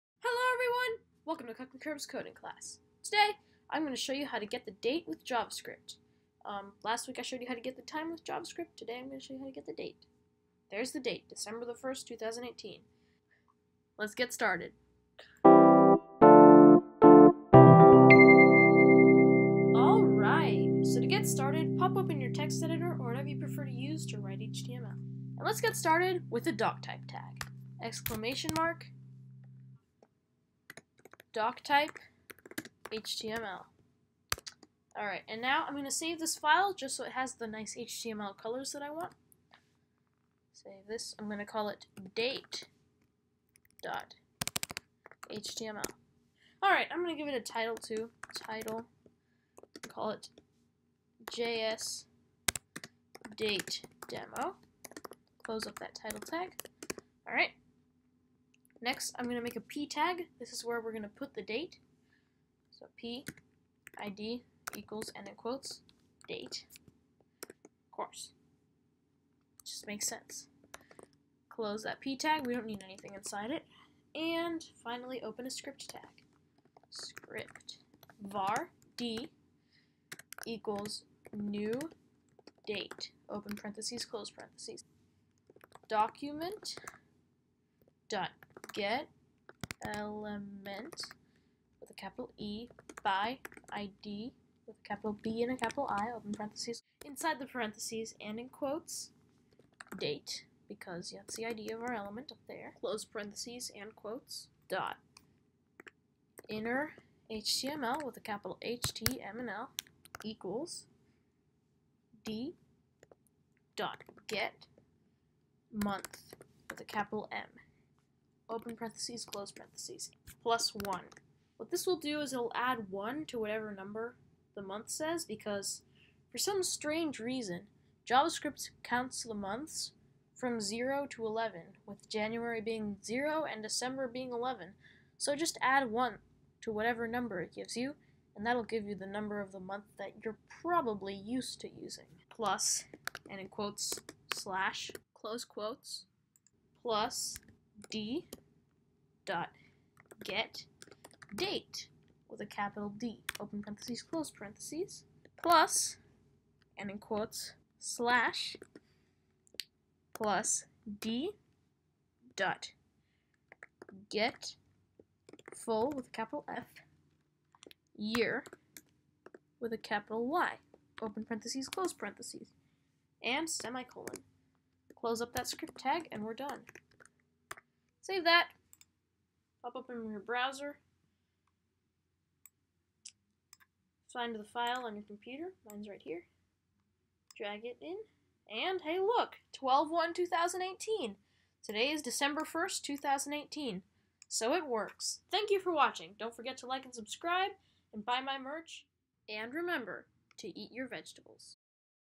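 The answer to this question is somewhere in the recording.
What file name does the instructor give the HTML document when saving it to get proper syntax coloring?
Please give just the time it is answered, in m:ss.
0:42.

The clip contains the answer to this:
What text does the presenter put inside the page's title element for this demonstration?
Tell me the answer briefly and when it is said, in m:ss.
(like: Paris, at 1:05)
JS date demo, at 0:51.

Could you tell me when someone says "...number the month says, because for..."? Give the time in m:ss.
2:03.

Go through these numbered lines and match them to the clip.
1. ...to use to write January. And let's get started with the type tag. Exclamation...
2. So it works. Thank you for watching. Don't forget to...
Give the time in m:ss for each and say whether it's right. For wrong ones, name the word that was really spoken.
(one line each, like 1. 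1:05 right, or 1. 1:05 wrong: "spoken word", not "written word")
1. 0:23 wrong: "HTML", not "January"
2. 3:14 right.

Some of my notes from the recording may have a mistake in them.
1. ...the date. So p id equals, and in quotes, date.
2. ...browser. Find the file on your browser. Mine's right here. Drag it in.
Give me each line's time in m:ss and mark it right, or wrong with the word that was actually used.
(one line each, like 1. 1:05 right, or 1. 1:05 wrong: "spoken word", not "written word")
1. 1:01 right
2. 3:00 wrong: "computer", not "browser".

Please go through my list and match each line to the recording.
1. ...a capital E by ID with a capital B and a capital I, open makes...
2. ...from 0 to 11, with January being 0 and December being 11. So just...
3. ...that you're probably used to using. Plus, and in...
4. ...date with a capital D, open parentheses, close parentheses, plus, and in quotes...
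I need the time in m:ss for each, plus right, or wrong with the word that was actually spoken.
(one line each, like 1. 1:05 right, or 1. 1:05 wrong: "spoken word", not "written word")
1. 1:31 wrong: "parentheses", not "makes"
2. 2:10 right
3. 2:19 right
4. 2:31 right.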